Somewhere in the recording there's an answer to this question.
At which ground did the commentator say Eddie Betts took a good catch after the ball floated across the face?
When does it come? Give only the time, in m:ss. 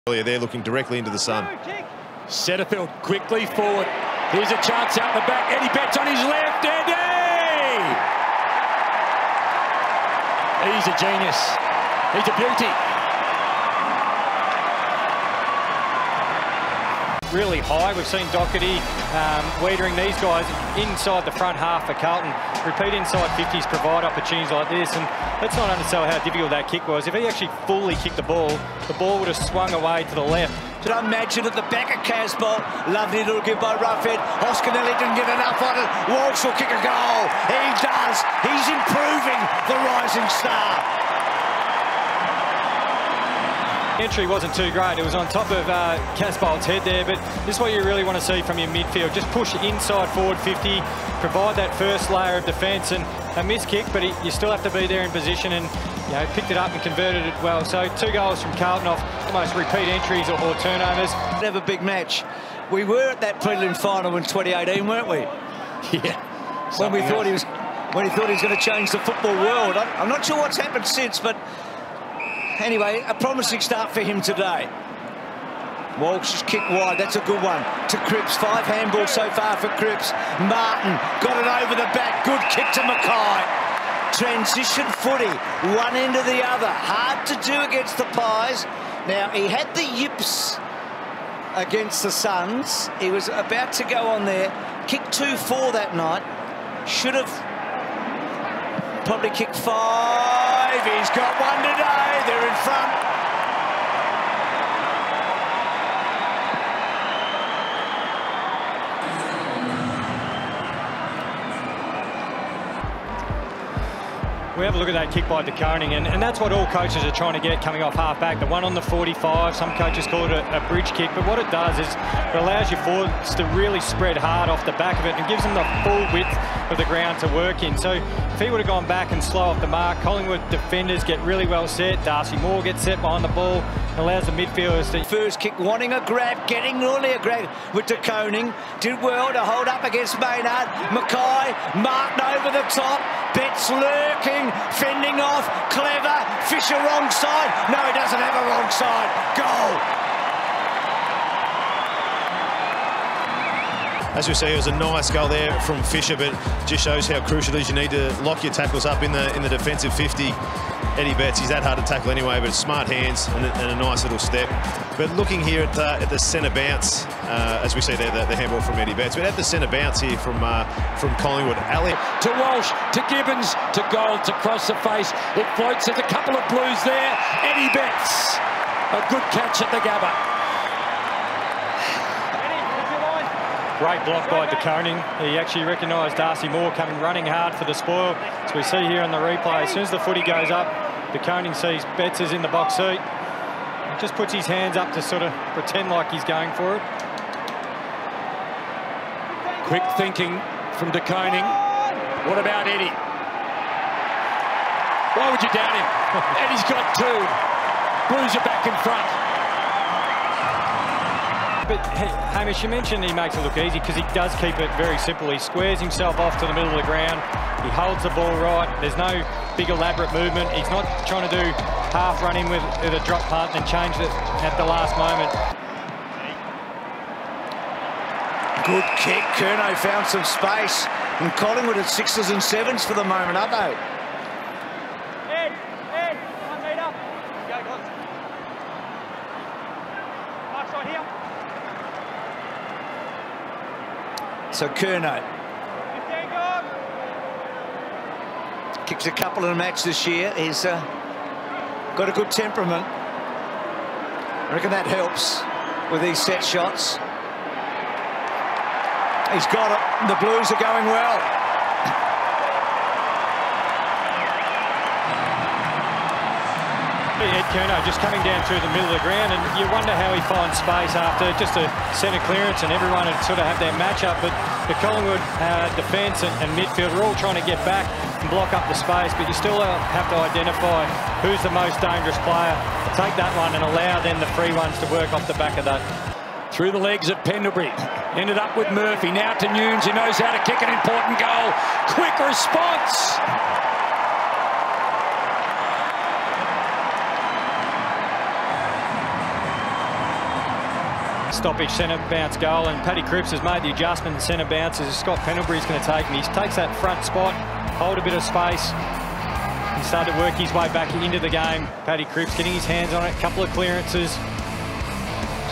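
2:59.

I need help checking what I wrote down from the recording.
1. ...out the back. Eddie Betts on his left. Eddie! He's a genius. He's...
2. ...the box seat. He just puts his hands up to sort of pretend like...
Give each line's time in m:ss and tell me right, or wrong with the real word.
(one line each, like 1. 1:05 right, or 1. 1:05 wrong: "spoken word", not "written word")
1. 0:04 right
2. 3:12 right.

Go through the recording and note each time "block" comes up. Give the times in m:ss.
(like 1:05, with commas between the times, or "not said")
3:04, 4:38.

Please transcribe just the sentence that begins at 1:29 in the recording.
Now, he had the yips against the Suns.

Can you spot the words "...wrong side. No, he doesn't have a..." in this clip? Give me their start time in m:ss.
2:26.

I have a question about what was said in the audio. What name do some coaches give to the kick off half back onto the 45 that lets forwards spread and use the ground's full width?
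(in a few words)
bridge kick.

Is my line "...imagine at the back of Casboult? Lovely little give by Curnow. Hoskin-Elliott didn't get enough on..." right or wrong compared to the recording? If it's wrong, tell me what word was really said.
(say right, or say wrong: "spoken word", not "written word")
wrong: "Ruffhead", not "Curnow".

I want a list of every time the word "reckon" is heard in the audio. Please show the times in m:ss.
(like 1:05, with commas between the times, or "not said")
4:14.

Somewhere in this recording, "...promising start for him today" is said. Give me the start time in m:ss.
1:13.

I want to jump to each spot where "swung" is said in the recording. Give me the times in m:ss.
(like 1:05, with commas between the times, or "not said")
0:29.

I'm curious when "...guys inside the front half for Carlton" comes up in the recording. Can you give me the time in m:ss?
0:20.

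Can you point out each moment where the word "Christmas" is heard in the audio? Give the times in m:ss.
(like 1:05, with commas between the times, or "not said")
not said.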